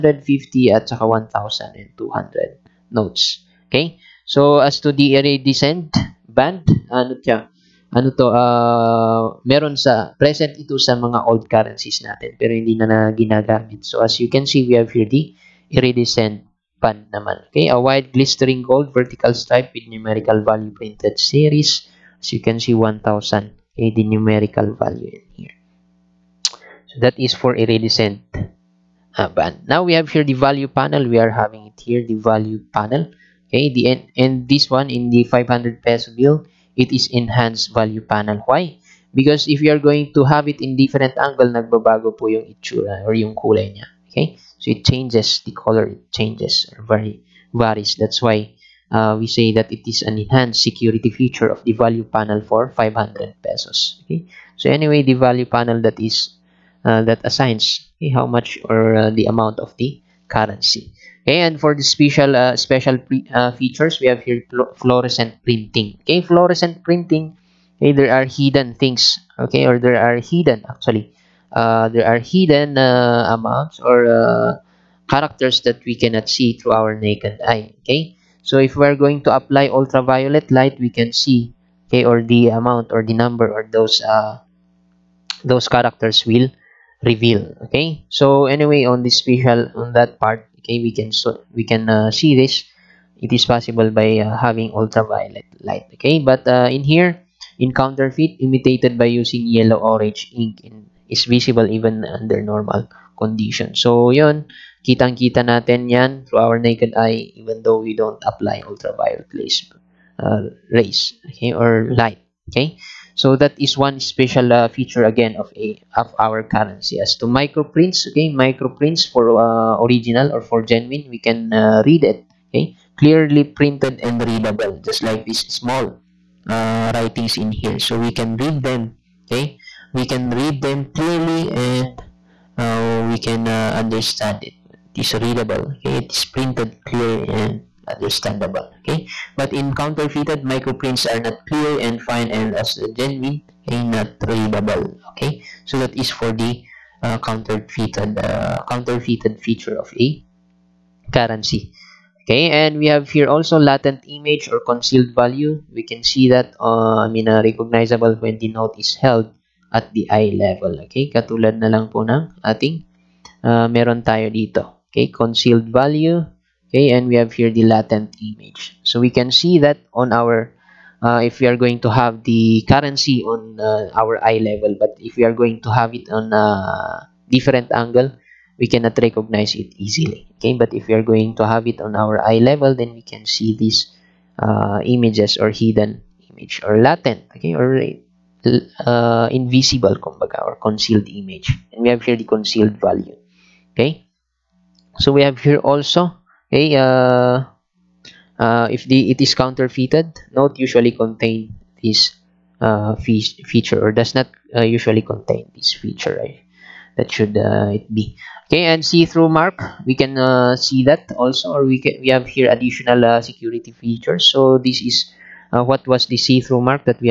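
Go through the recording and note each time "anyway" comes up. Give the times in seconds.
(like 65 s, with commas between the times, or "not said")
54 s, 88 s.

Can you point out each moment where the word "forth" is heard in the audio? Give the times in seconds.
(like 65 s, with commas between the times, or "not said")
not said.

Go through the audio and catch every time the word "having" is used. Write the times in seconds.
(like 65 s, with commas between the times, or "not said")
31 s, 94 s.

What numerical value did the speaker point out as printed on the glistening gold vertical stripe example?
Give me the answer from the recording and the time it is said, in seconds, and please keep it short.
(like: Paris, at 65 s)
1,000, at 22 s.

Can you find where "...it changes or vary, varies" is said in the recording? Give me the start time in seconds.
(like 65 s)
45 s.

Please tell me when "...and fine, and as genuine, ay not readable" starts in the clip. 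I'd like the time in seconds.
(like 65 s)
141 s.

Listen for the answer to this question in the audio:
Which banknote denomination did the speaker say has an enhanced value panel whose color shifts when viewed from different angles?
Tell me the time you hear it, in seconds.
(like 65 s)
35 s.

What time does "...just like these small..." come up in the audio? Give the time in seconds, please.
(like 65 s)
124 s.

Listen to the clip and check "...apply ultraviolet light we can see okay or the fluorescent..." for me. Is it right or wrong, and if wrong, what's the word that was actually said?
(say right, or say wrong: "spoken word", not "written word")
wrong: "amount", not "fluorescent".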